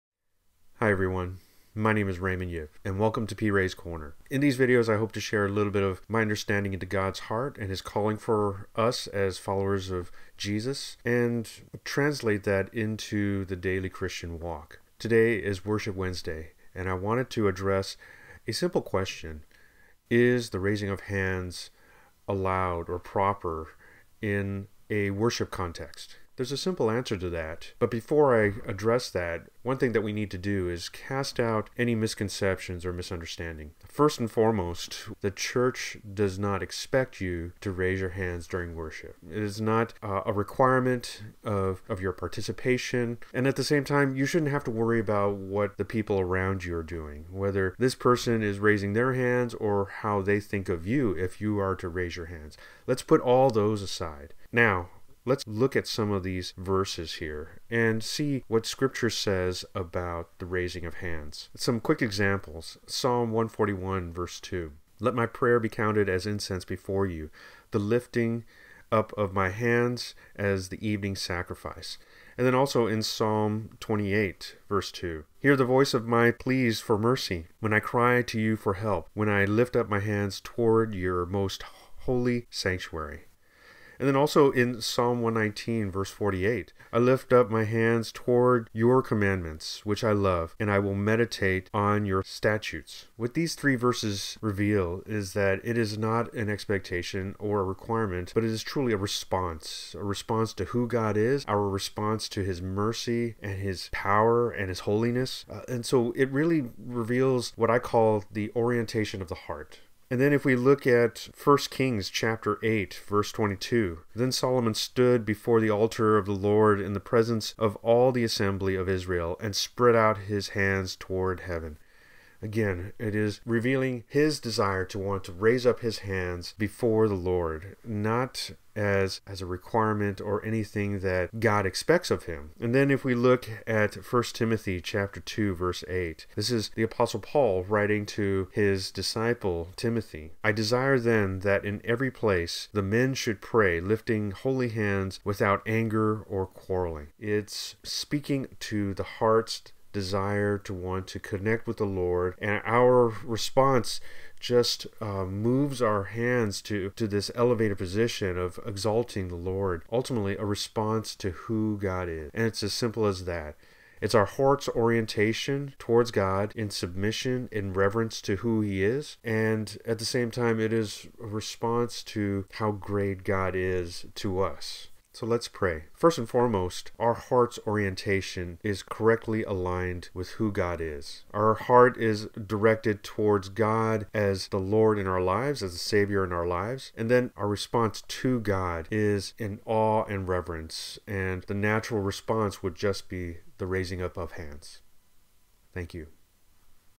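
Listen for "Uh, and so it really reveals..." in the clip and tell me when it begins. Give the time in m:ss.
1:45.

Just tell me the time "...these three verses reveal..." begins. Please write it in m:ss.
1:33.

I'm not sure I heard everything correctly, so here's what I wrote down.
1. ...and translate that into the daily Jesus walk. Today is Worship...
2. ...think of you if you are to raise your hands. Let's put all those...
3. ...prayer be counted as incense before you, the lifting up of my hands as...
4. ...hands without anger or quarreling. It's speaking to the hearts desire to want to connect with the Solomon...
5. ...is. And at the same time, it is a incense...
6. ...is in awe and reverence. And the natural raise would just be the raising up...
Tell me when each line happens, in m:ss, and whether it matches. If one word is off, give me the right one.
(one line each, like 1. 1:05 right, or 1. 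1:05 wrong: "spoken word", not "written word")
1. 0:11 wrong: "Christian", not "Jesus"
2. 0:50 right
3. 1:05 right
4. 2:24 wrong: "Lord", not "Solomon"
5. 2:48 wrong: "response", not "incense"
6. 3:08 wrong: "response", not "raise".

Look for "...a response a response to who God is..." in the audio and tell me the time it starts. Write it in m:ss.
1:38.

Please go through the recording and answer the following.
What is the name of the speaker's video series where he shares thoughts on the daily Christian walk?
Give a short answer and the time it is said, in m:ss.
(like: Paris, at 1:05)
PRay's Corner, at 0:03.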